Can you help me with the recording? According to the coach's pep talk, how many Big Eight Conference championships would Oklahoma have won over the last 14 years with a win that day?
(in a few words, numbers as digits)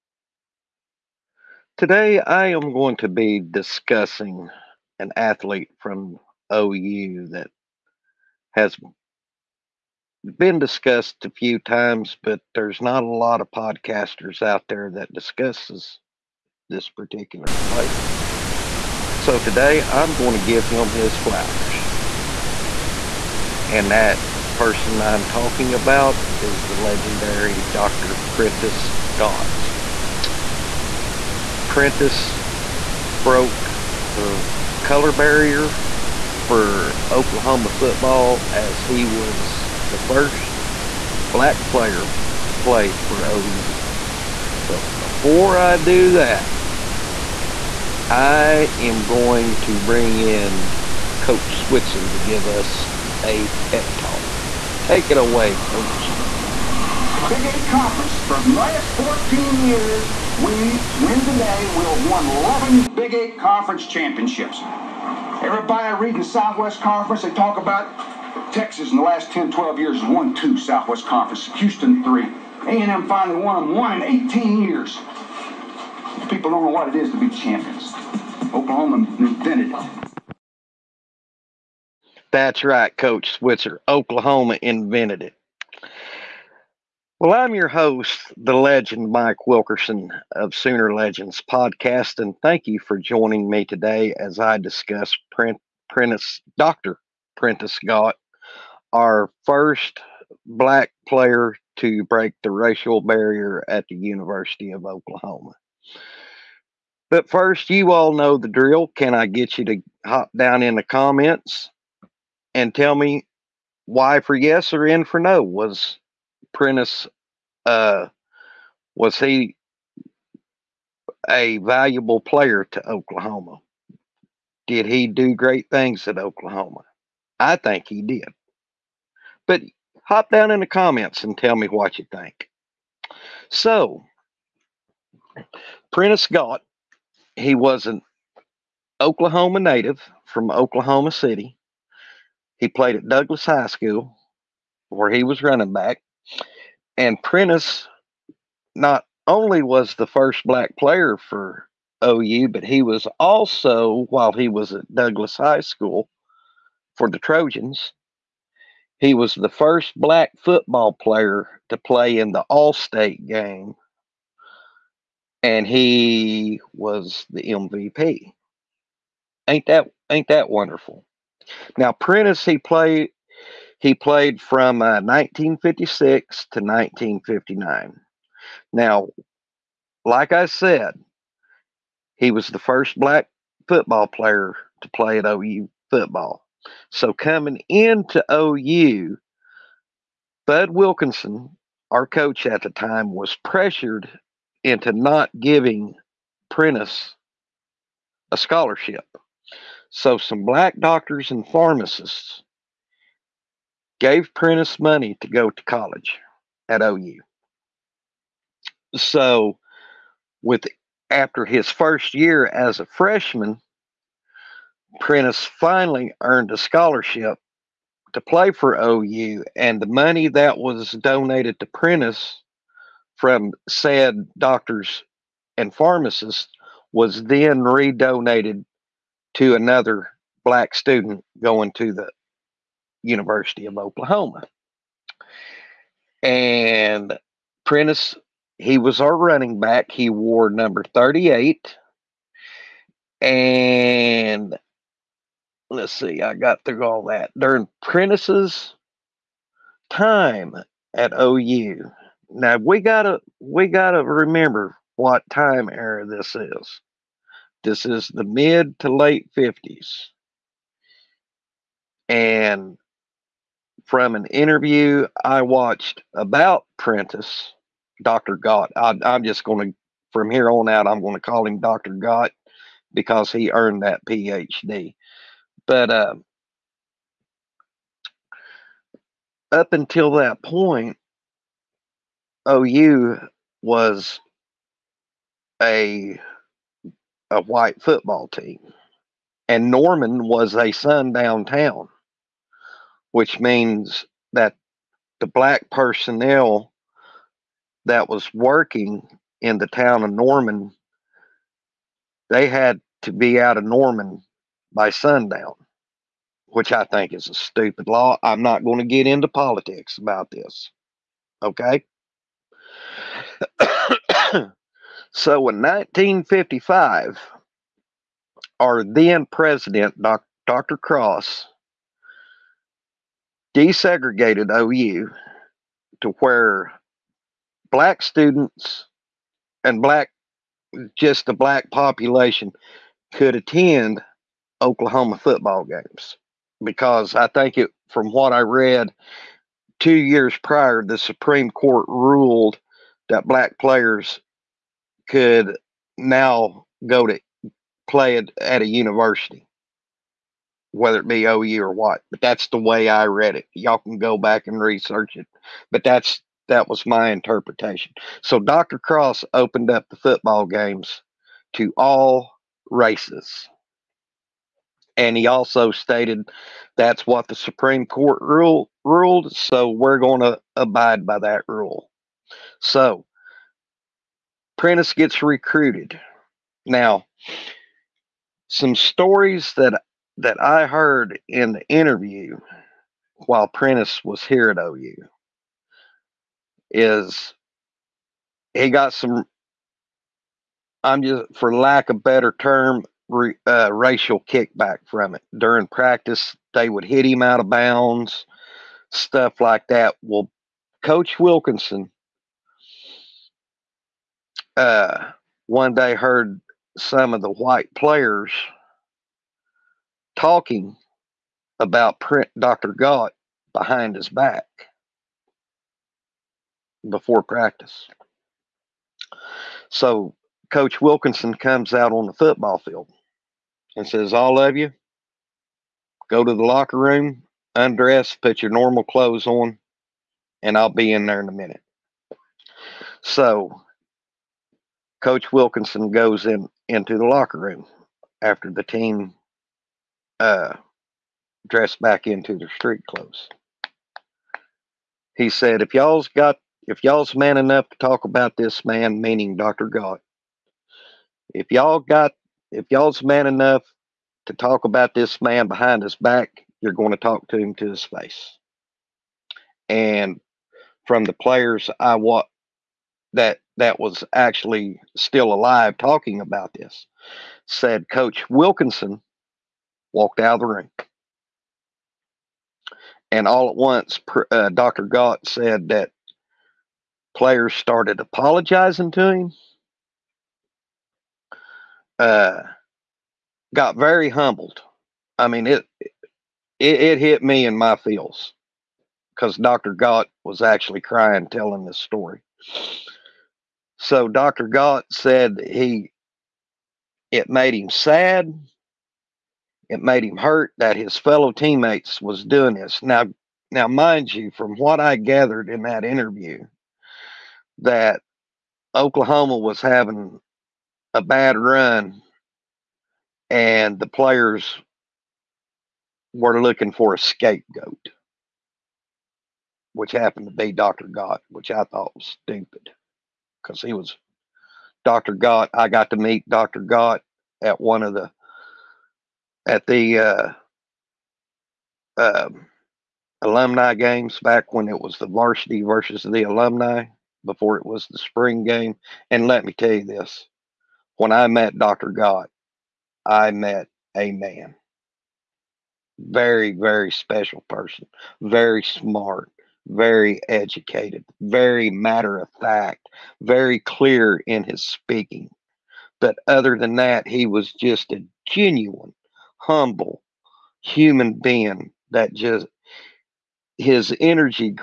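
11.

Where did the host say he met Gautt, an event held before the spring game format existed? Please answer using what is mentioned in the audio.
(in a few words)
alumni games.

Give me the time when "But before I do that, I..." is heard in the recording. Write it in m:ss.
0:44.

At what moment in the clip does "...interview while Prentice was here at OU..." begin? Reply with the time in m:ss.
6:21.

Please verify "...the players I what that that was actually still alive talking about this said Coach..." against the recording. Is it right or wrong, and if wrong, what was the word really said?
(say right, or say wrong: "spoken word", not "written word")
right.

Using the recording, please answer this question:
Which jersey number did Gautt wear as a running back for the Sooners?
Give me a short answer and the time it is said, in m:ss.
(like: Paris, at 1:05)
38, at 4:00.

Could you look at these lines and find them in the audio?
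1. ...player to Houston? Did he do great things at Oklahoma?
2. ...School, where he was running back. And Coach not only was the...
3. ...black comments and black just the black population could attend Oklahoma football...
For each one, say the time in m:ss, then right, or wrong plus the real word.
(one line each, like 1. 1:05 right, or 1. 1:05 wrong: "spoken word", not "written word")
1. 2:02 wrong: "Oklahoma", not "Houston"
2. 2:23 wrong: "Prentice", not "Coach"
3. 5:27 wrong: "students", not "comments".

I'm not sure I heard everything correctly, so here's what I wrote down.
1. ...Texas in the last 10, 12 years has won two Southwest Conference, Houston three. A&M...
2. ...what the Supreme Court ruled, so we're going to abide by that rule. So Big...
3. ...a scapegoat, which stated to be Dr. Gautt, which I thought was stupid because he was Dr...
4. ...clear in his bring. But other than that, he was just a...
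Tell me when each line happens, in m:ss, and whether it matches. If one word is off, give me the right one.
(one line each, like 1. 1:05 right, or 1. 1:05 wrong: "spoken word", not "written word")
1. 1:08 right
2. 6:07 wrong: "Prentice", not "Big"
3. 8:36 wrong: "happened", not "stated"
4. 9:13 wrong: "speaking", not "bring".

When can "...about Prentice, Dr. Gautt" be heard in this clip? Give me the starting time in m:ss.
4:26.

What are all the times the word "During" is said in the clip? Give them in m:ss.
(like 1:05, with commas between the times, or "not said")
4:07, 6:35.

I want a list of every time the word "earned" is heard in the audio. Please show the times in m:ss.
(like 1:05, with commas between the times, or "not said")
3:36, 4:33.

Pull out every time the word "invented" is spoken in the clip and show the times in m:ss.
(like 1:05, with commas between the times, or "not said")
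1:19, 1:24.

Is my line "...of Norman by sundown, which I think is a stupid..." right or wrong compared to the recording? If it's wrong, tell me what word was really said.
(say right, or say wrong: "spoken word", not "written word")
right.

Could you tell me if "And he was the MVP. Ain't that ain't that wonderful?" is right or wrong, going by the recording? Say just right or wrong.
right.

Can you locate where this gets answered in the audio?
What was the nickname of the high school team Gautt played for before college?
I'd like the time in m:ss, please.
2:37.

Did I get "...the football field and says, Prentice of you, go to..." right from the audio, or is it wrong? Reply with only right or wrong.
wrong.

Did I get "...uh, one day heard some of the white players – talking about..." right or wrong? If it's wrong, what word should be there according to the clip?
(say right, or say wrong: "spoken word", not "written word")
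right.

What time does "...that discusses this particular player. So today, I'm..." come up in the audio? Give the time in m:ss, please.
0:14.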